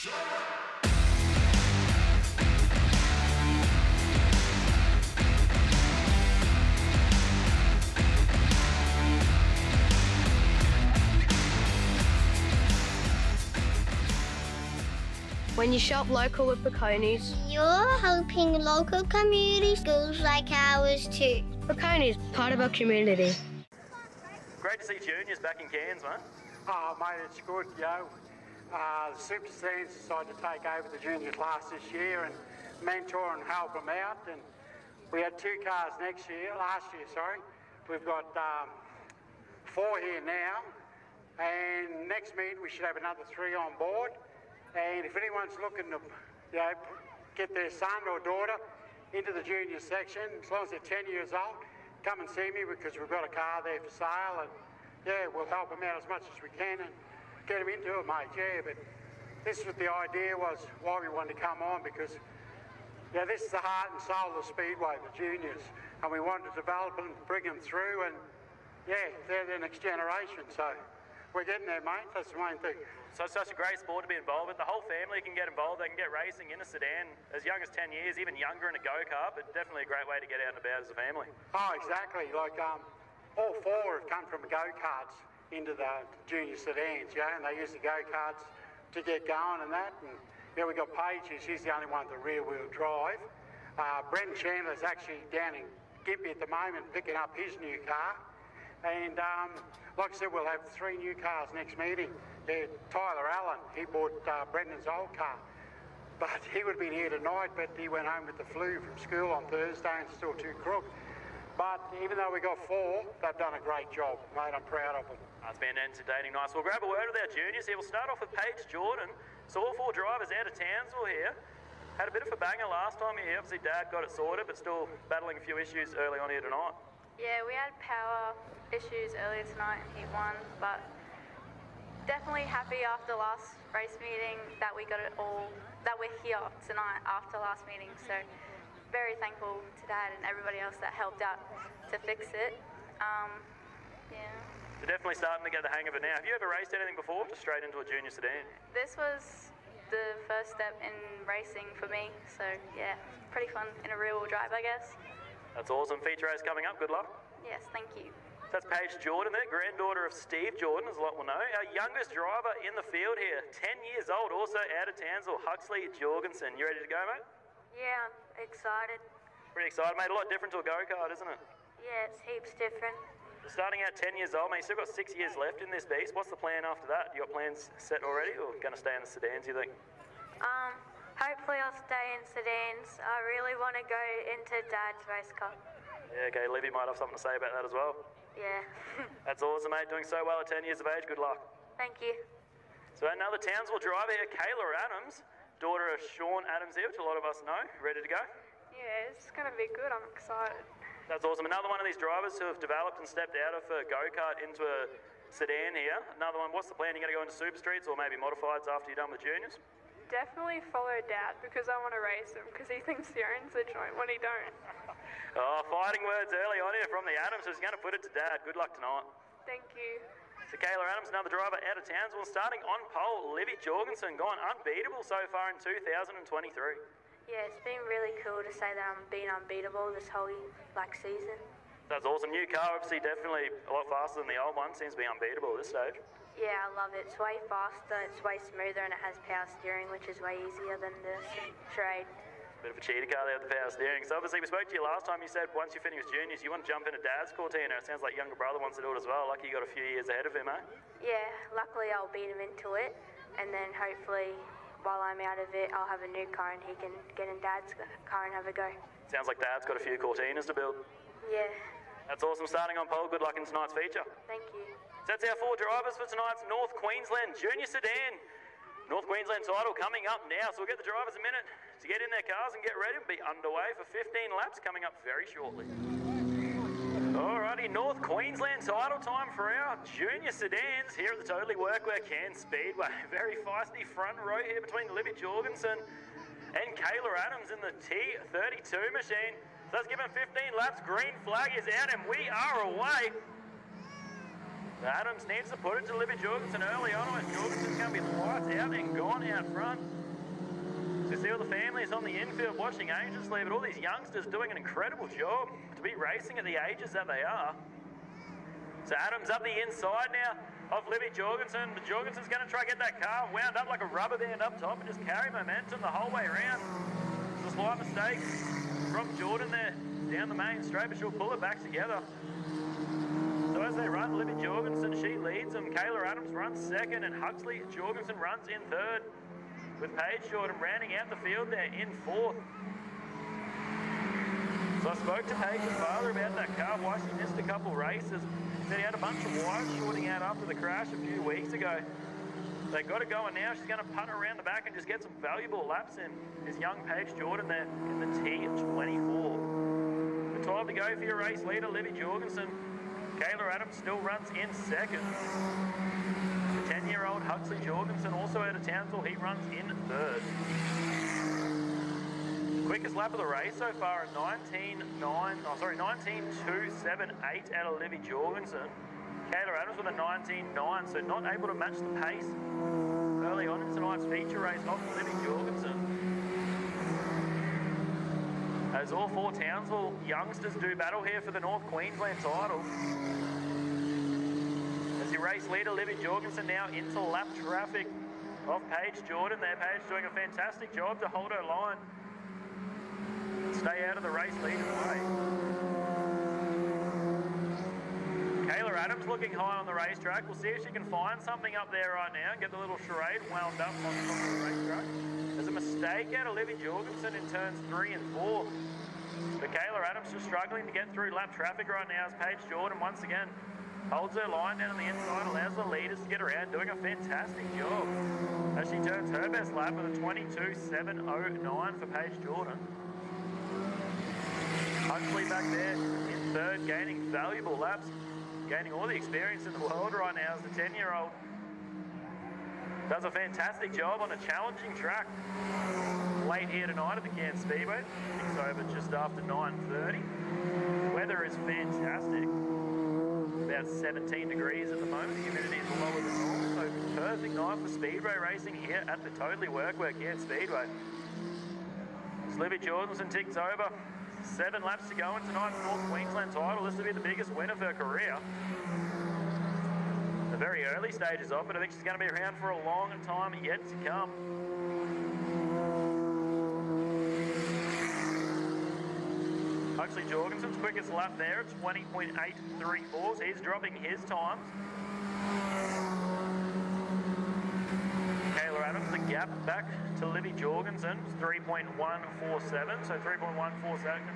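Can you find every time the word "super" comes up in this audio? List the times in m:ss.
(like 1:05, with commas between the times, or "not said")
0:29, 3:27.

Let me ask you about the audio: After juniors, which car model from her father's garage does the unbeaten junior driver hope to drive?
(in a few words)
Cortina.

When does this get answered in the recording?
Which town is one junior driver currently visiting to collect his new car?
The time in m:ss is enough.
1:36.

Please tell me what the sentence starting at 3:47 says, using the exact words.
Yeah, it's been really cool to say that I'm being unbeatable this whole like season.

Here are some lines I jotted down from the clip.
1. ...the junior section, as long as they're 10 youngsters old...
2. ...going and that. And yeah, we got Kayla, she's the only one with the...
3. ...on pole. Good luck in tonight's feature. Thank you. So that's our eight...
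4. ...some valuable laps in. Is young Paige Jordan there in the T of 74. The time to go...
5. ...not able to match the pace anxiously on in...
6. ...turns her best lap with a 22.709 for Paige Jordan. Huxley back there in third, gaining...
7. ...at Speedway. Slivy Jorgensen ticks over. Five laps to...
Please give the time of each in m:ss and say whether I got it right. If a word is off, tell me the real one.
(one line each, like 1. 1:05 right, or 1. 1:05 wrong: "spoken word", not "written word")
1. 0:49 wrong: "years", not "youngsters"
2. 1:29 wrong: "Paige", not "Kayla"
3. 4:22 wrong: "four", not "eight"
4. 5:45 wrong: "24", not "74"
5. 6:11 wrong: "early", not "anxiously"
6. 6:58 right
7. 7:30 wrong: "Seven", not "Five".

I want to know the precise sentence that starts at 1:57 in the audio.
We'll start off with Paige Jordan.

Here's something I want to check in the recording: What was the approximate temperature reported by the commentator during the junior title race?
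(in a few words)
17 degrees.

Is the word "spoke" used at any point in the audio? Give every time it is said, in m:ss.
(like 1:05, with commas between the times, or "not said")
4:04, 5:34.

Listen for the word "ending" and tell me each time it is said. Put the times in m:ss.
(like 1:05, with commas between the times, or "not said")
not said.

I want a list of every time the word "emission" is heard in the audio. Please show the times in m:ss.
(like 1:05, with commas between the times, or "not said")
not said.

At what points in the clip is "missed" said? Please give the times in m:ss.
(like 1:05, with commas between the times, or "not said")
5:37.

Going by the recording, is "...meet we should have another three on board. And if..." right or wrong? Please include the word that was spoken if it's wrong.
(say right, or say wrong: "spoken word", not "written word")
right.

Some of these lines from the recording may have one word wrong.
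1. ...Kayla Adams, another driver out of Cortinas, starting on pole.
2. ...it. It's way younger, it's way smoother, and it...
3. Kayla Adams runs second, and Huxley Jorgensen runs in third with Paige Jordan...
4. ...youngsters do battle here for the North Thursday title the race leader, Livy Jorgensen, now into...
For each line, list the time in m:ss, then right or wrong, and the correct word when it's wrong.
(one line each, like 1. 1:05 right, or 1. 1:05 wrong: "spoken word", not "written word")
1. 3:40 wrong: "Townsville", not "Cortinas"
2. 3:56 wrong: "faster", not "younger"
3. 5:25 right
4. 6:20 wrong: "Queensland", not "Thursday".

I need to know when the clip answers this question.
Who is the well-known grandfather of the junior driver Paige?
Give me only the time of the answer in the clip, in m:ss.
2:40.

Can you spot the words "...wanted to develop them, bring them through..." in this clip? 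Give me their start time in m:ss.
1:06.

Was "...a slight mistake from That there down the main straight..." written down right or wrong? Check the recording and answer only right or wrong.
wrong.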